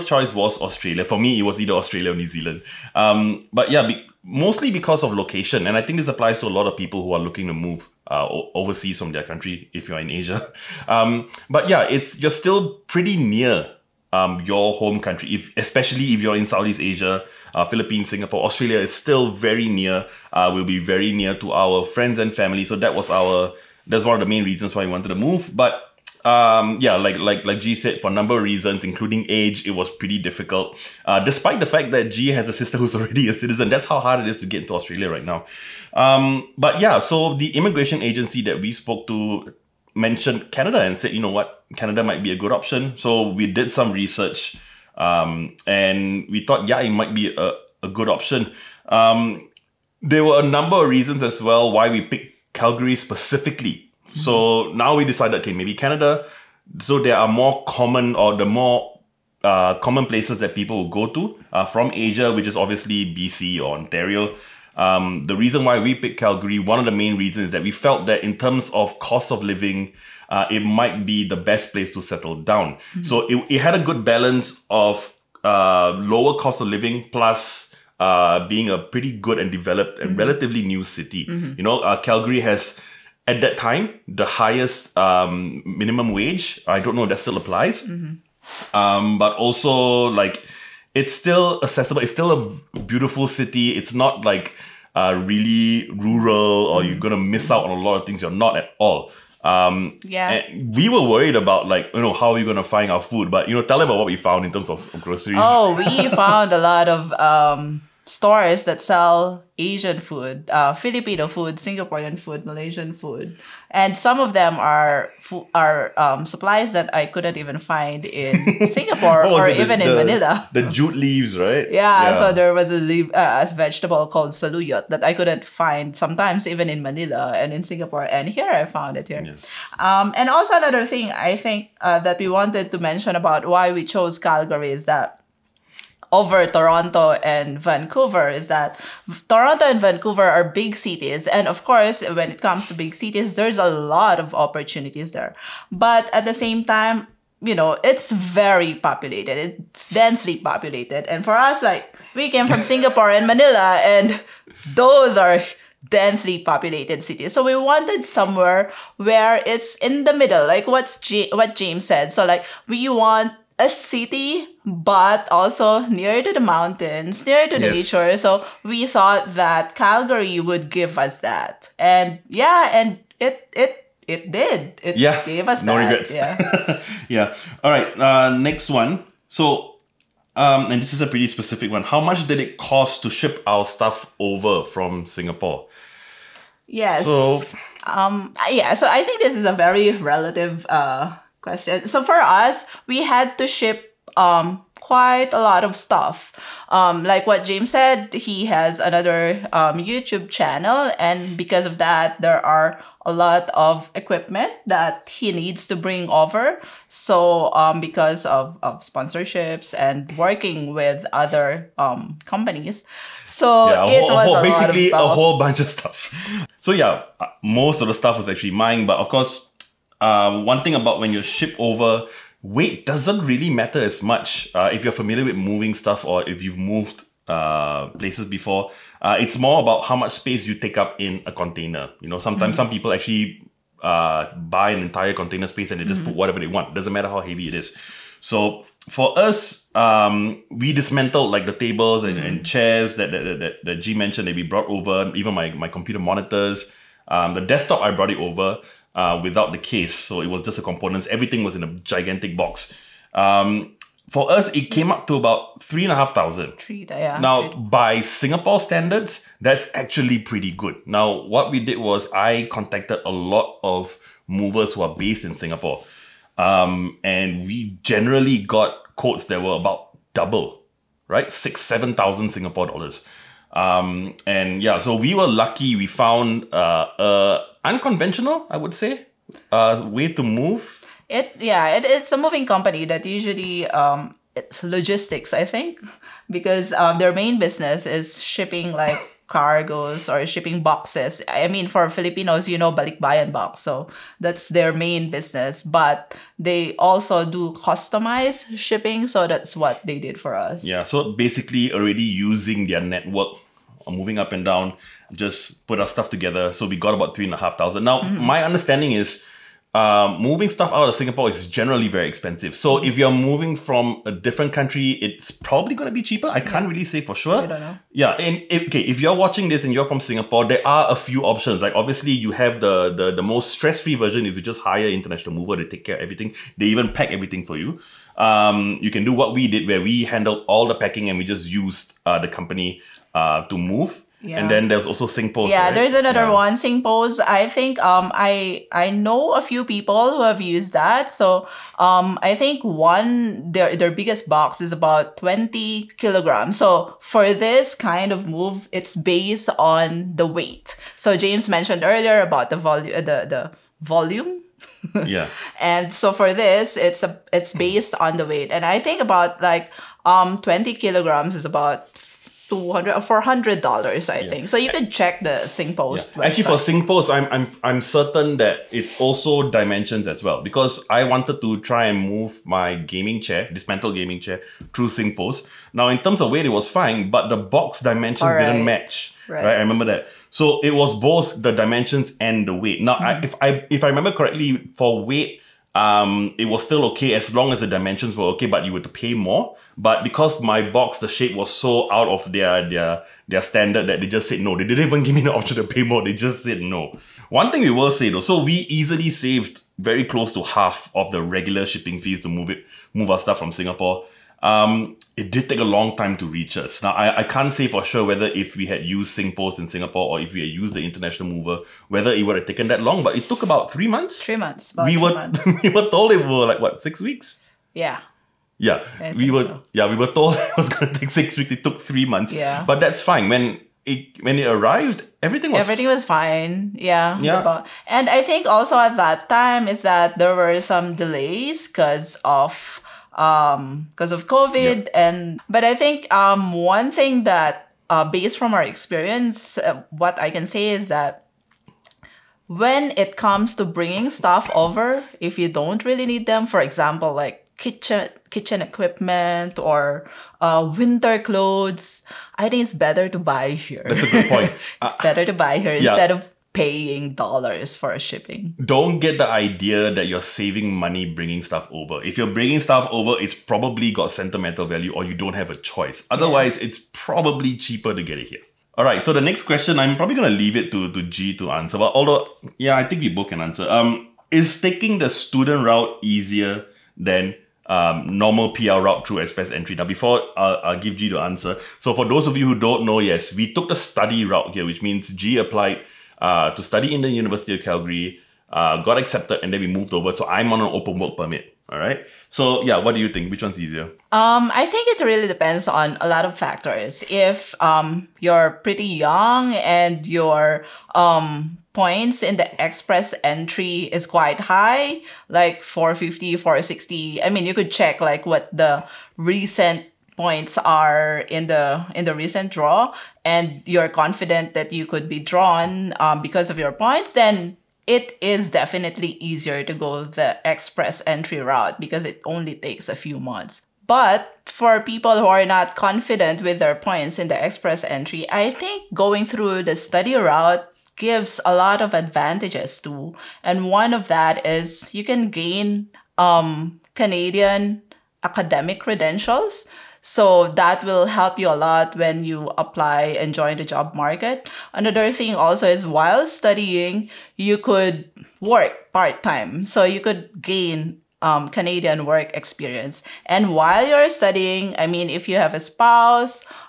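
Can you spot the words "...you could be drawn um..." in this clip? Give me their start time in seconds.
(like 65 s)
514 s.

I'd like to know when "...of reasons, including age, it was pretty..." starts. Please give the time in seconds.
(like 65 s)
28 s.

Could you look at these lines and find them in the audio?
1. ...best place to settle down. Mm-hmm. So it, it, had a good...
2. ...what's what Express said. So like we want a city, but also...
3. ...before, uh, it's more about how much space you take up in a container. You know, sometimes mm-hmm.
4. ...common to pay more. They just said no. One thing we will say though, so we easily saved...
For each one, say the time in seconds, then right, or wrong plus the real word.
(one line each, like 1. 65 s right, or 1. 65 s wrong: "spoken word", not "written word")
1. 71 s right
2. 160 s wrong: "James", not "Express"
3. 228 s right
4. 395 s wrong: "option", not "common".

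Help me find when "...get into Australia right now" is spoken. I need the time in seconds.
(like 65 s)
34 s.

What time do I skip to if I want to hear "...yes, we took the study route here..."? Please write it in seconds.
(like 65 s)
482 s.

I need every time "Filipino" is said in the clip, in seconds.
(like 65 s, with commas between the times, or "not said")
110 s, 291 s.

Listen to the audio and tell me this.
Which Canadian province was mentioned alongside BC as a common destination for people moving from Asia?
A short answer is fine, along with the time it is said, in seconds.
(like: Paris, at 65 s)
Ontario, at 63 s.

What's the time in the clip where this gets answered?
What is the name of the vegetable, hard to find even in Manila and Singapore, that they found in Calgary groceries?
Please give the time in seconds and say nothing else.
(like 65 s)
124 s.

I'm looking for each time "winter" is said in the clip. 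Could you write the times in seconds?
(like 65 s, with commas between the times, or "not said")
450 s.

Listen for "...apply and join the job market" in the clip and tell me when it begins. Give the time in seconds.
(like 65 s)
542 s.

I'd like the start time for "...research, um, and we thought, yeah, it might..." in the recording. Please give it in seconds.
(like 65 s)
43 s.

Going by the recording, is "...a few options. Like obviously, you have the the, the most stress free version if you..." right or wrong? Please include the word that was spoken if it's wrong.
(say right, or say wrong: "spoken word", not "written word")
right.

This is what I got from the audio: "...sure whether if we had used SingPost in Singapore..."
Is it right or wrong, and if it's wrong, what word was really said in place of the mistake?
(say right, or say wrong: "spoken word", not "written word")
right.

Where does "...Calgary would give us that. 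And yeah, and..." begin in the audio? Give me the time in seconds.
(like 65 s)
169 s.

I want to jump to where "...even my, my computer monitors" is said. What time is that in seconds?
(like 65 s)
245 s.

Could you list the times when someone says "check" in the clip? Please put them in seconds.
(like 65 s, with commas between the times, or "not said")
364 s, 507 s.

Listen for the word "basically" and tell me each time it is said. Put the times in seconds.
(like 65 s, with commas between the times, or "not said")
214 s, 301 s.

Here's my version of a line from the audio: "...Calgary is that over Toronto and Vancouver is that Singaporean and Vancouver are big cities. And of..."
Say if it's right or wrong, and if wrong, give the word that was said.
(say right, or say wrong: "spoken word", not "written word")
wrong: "Toronto", not "Singaporean".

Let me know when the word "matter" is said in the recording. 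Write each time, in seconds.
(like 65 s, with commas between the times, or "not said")
223 s, 236 s.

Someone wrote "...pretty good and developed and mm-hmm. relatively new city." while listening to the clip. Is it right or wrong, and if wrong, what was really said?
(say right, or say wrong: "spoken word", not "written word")
right.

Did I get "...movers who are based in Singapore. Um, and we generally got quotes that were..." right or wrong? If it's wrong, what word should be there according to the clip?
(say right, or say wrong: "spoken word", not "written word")
right.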